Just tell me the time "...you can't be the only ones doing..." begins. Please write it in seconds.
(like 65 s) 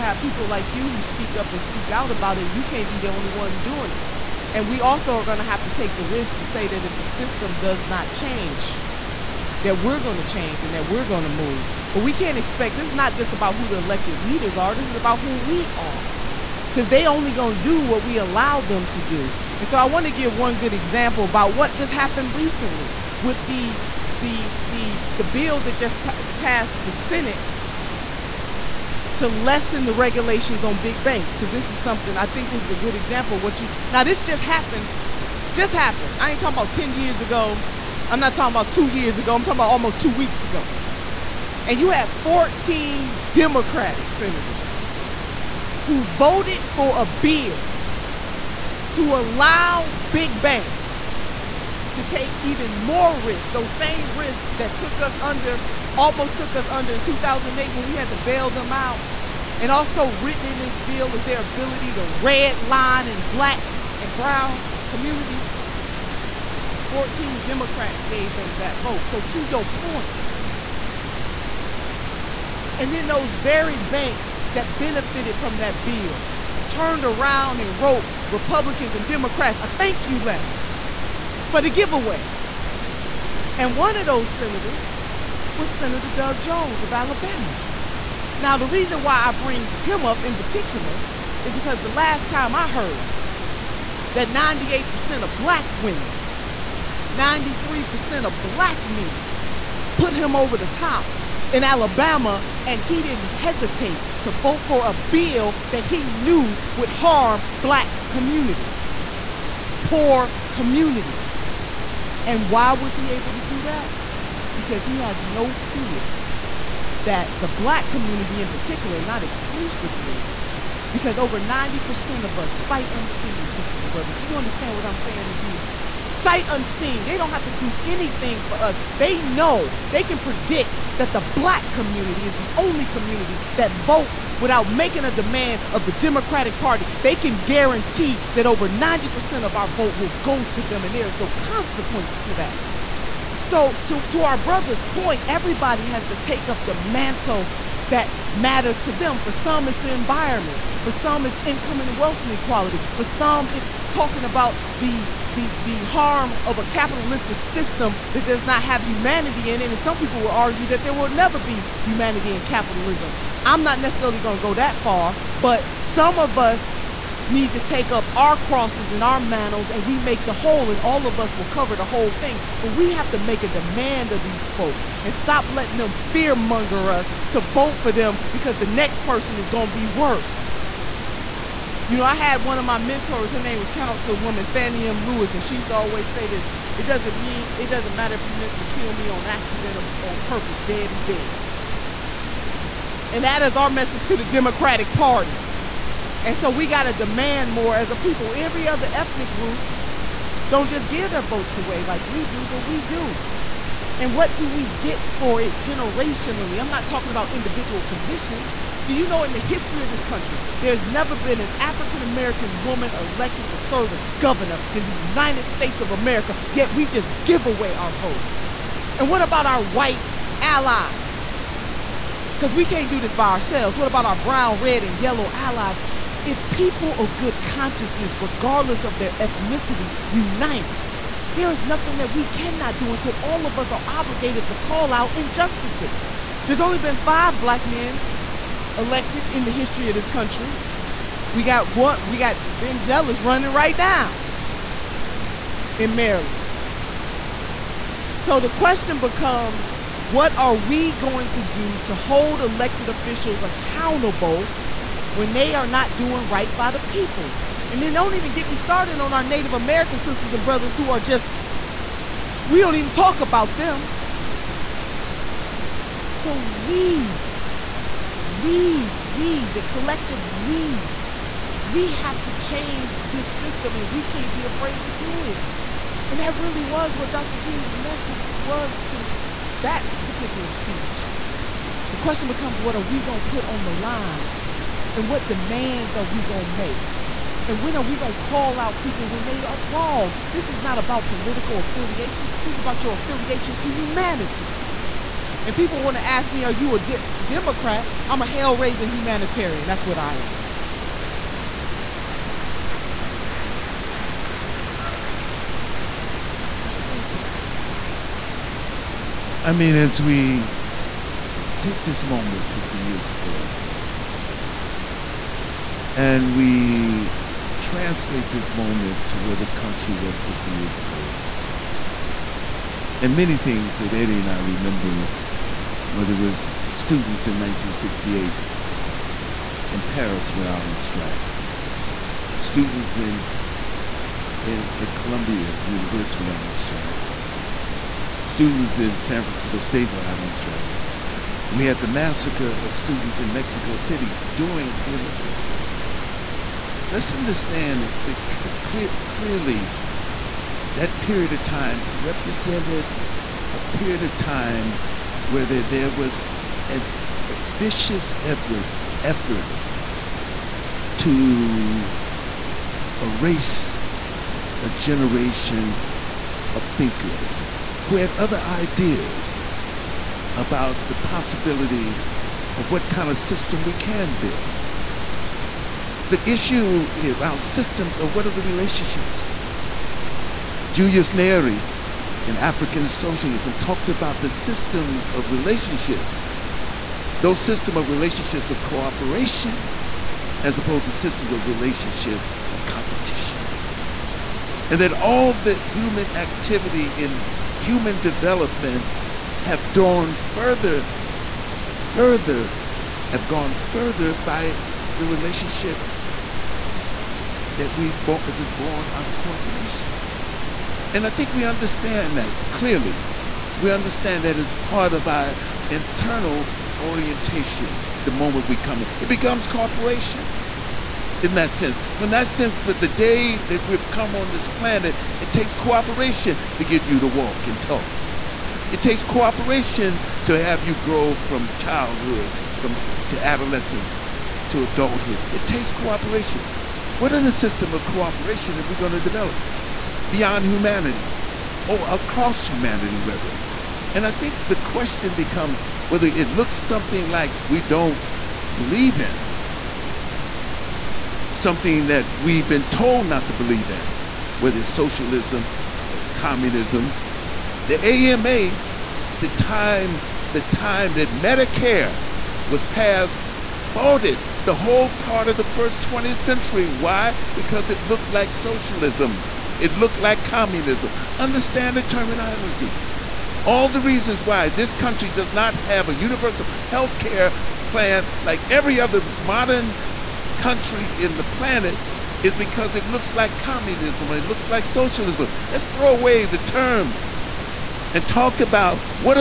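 2 s.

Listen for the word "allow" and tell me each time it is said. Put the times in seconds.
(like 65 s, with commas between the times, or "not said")
18 s, 49 s.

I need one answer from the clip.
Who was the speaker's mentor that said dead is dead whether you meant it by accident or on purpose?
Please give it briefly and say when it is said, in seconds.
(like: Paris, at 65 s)
Fannie M. Lewis, at 184 s.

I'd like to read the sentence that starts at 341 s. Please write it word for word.
We had the massacre of students in Mexico City during the Olympics.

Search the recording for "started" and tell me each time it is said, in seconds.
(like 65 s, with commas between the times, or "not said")
258 s.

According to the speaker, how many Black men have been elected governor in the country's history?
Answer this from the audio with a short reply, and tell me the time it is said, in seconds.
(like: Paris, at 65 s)
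five, at 236 s.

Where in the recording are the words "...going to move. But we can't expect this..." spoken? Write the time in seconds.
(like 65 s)
11 s.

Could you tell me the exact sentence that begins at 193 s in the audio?
And that is our message to the Democratic Party.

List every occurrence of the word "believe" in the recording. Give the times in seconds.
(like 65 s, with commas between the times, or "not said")
448 s, 453 s.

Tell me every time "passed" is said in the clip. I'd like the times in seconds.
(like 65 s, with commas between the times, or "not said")
26 s, 462 s.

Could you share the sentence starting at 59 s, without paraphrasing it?
And also written in this bill is their ability to red line in black and brown communities.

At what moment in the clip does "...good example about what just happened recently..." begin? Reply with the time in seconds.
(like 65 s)
20 s.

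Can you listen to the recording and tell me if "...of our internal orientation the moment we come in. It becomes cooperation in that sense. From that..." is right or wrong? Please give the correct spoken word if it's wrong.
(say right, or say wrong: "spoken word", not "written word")
right.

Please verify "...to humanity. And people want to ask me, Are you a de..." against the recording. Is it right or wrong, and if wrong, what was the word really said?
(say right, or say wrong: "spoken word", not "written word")
right.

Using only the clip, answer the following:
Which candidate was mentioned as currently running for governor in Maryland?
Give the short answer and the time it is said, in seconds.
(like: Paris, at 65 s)
Ben Jealous, at 242 s.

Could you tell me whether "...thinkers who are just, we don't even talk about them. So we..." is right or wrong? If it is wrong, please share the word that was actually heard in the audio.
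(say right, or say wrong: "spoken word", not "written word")
wrong: "brothers", not "thinkers".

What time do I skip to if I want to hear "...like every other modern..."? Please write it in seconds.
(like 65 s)
478 s.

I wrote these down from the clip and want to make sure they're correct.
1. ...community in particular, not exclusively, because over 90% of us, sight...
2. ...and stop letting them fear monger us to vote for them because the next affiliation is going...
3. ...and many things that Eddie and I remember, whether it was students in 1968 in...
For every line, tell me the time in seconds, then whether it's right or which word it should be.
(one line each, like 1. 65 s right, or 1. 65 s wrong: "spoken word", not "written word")
1. 117 s right
2. 175 s wrong: "person", not "affiliation"
3. 322 s right.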